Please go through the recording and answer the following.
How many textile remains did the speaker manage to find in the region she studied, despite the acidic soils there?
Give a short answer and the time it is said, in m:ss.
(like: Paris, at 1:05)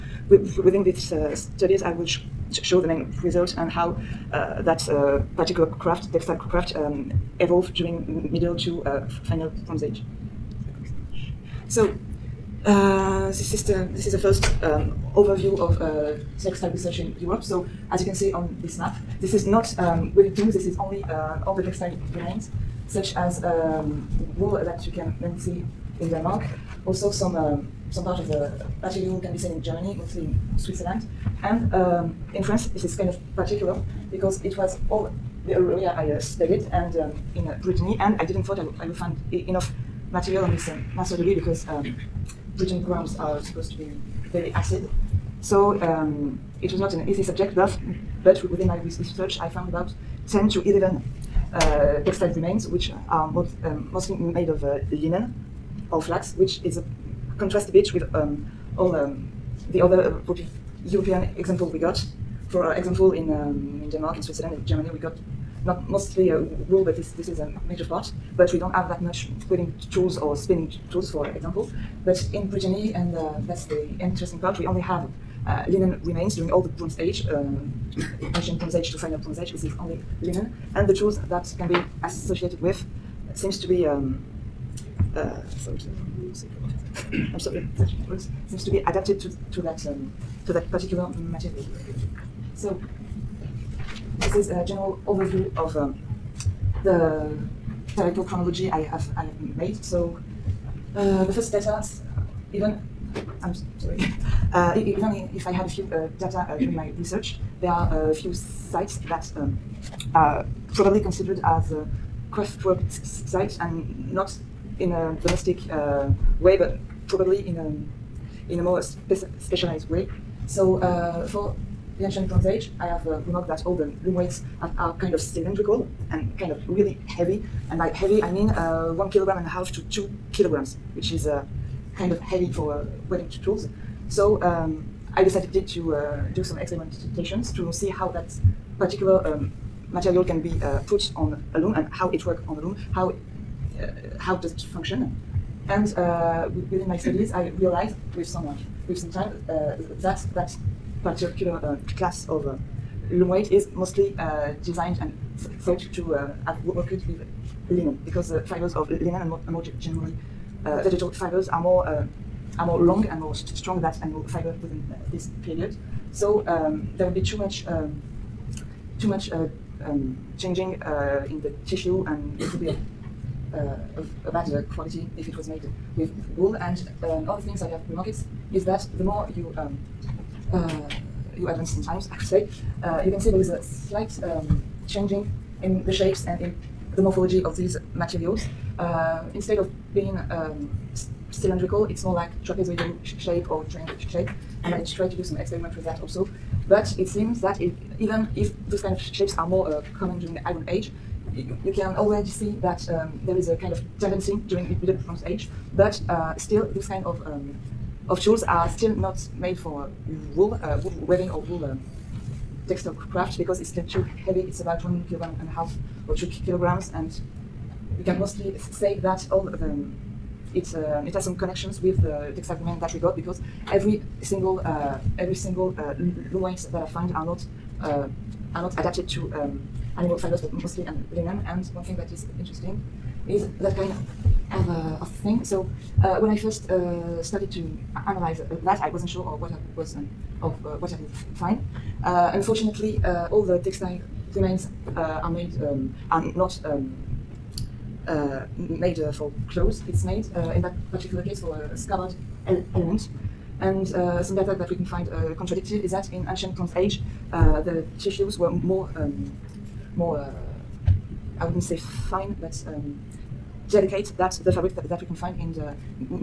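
10 to 11, at 0:50.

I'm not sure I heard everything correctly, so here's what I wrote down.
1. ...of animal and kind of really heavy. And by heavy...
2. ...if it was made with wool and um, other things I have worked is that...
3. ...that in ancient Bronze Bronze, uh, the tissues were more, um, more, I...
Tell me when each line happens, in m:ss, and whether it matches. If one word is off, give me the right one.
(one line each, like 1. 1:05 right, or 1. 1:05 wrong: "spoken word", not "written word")
1. 2:05 wrong: "cylindrical", not "animal"
2. 2:55 wrong: "remarked", not "worked"
3. 4:15 wrong: "Age", not "Bronze".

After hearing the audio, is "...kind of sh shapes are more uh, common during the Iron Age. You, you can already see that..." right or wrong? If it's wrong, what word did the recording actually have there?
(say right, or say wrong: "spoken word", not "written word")
right.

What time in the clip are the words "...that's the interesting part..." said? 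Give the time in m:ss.
1:13.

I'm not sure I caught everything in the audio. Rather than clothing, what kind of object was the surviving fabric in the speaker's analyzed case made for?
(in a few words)
a scabbard.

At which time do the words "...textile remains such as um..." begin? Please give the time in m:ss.
0:21.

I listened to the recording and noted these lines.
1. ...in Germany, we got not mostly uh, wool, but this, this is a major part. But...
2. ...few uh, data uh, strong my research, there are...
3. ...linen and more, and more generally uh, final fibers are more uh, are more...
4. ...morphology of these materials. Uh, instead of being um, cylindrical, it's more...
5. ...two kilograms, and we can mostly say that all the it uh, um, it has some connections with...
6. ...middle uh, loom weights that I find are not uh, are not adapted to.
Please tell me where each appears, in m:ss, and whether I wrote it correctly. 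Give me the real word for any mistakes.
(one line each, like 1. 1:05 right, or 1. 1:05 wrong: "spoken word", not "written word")
1. 1:04 right
2. 1:45 wrong: "during", not "strong"
3. 2:38 wrong: "vegetal", not "final"
4. 3:07 right
5. 3:36 right
6. 3:45 wrong: "single", not "middle".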